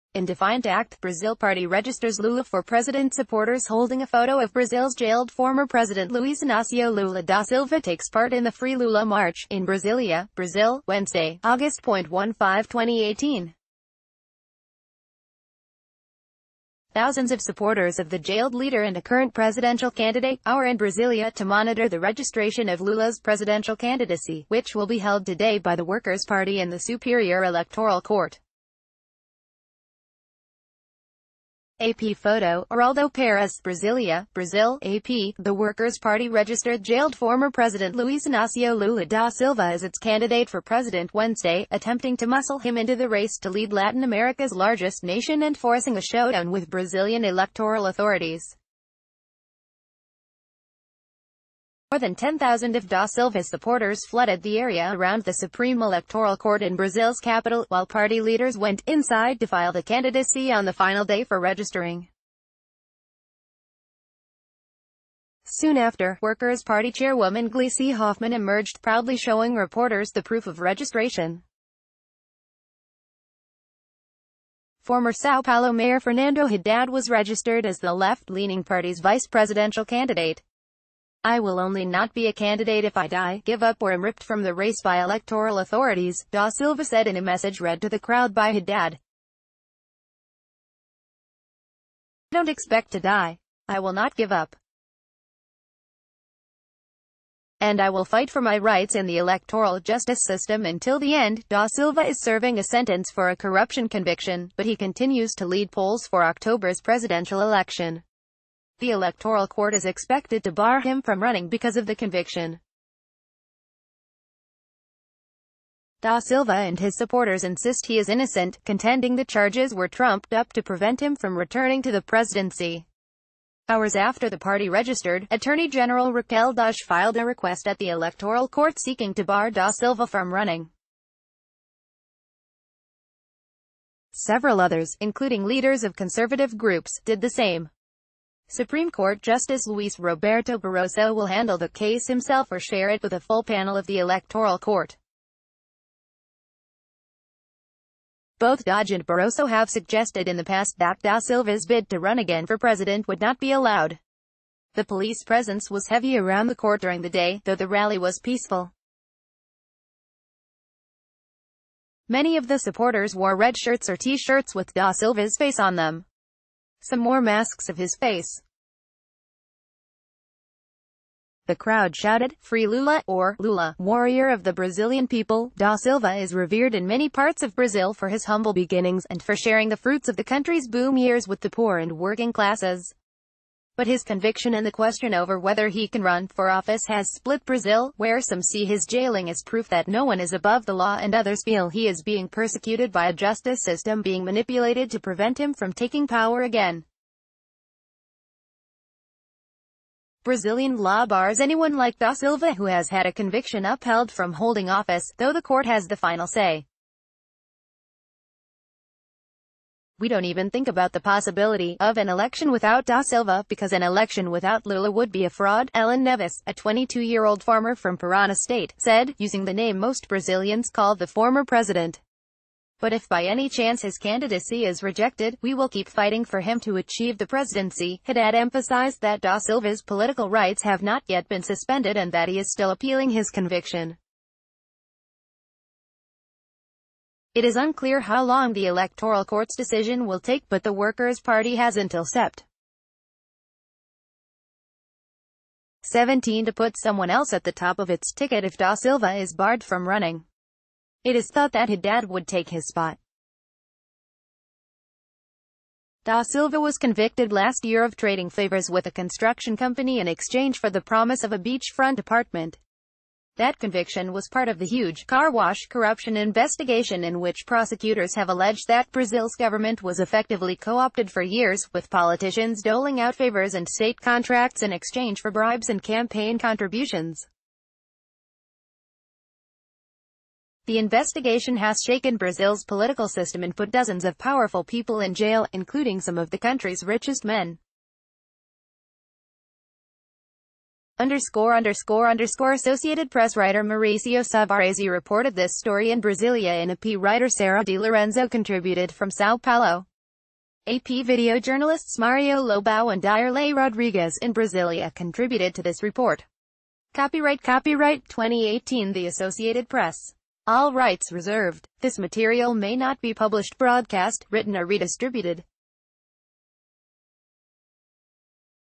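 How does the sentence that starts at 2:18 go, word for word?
Supreme Court Justice Luis Roberto Barroso will handle the case himself or share it with a full panel of the Electoral Court.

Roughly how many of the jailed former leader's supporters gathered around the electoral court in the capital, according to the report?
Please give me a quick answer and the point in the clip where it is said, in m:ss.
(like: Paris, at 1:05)
More than 10,000, at 0:51.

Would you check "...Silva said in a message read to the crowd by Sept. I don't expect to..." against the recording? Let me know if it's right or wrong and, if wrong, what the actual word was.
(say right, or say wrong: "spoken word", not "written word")
wrong: "Haddad", not "Sept".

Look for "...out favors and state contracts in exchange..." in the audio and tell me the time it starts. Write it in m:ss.
4:33.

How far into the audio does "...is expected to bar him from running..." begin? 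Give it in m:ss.
1:49.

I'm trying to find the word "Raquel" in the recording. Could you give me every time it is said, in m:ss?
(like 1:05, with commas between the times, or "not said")
2:06.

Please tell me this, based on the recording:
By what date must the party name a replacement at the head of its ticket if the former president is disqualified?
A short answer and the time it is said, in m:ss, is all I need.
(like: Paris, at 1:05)
Sept. 17, at 4:02.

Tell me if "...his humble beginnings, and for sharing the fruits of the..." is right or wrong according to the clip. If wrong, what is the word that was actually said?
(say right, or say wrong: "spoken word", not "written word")
right.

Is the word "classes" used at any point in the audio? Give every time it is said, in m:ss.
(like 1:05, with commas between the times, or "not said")
3:02.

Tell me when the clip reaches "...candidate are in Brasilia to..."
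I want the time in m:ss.
0:19.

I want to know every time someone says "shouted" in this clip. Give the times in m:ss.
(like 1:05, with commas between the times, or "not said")
2:51.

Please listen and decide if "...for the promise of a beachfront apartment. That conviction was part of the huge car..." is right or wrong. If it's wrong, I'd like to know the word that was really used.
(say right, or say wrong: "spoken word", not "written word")
right.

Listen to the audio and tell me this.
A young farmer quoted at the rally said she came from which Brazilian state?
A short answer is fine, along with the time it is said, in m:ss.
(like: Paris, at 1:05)
Parana, at 3:37.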